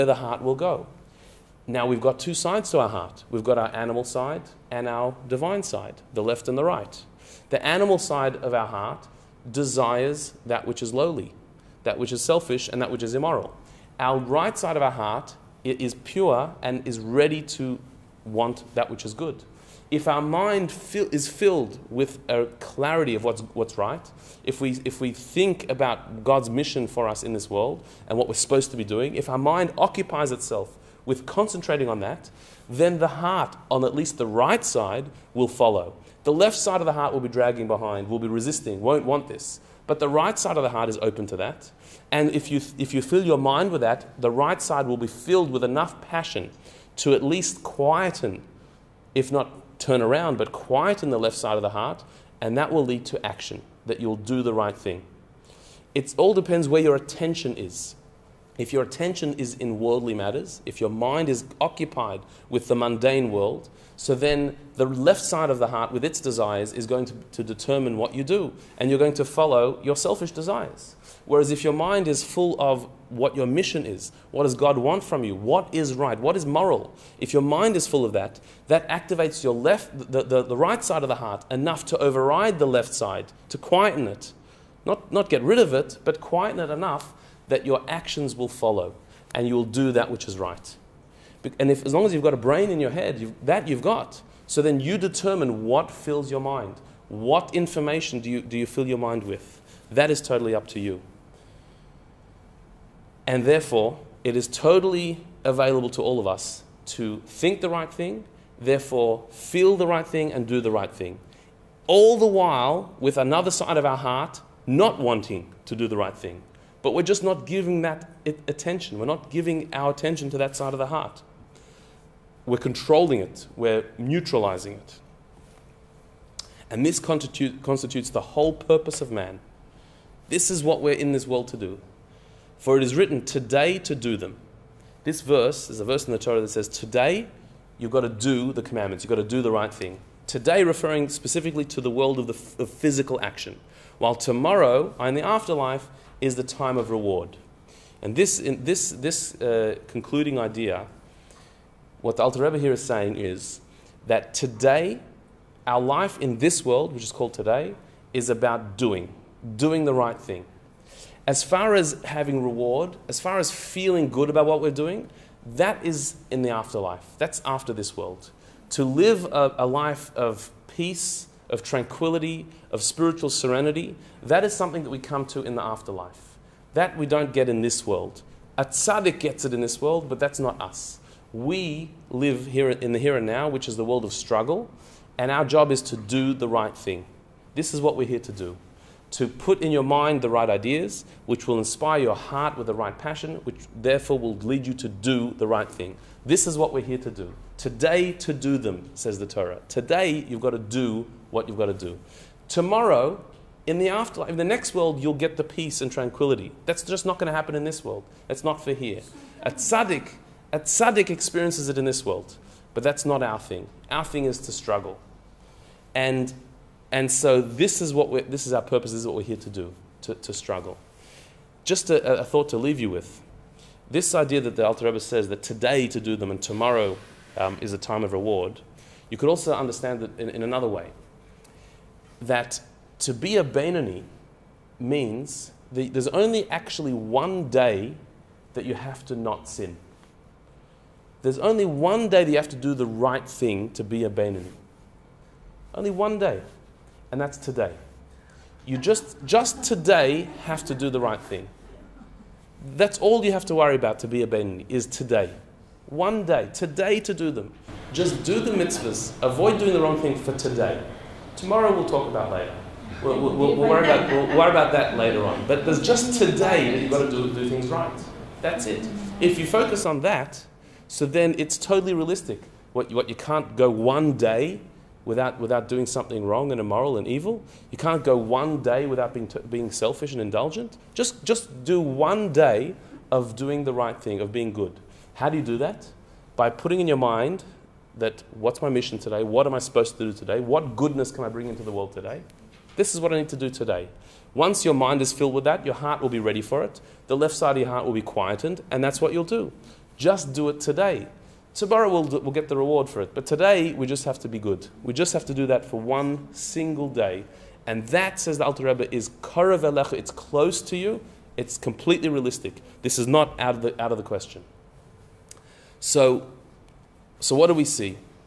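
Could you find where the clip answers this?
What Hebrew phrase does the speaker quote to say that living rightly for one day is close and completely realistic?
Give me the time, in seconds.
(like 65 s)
309 s.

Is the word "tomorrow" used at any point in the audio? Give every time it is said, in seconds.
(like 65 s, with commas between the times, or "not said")
144 s, 202 s, 226 s, 261 s, 301 s.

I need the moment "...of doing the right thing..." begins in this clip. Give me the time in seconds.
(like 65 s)
283 s.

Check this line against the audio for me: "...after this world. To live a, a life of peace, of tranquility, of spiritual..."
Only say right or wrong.
right.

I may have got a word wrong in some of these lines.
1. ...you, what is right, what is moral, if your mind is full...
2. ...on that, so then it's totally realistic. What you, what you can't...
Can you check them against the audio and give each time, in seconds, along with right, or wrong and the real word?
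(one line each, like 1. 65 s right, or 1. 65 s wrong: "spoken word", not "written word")
1. 75 s right
2. 269 s right.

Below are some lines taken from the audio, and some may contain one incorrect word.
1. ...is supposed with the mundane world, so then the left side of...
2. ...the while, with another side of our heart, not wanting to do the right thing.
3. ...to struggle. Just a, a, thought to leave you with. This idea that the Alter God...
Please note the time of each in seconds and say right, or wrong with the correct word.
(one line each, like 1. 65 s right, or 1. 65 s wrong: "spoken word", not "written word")
1. 61 s wrong: "occupied", not "supposed"
2. 112 s right
3. 220 s wrong: "Rebbe", not "God".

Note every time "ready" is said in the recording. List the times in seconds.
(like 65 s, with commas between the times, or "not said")
16 s, 296 s.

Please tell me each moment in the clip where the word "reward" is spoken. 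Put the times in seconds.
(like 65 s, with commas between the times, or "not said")
146 s, 162 s, 228 s, 302 s.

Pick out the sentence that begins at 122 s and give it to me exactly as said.
We're controlling it, we're neutralizing it.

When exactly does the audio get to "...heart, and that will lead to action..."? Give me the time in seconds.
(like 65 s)
51 s.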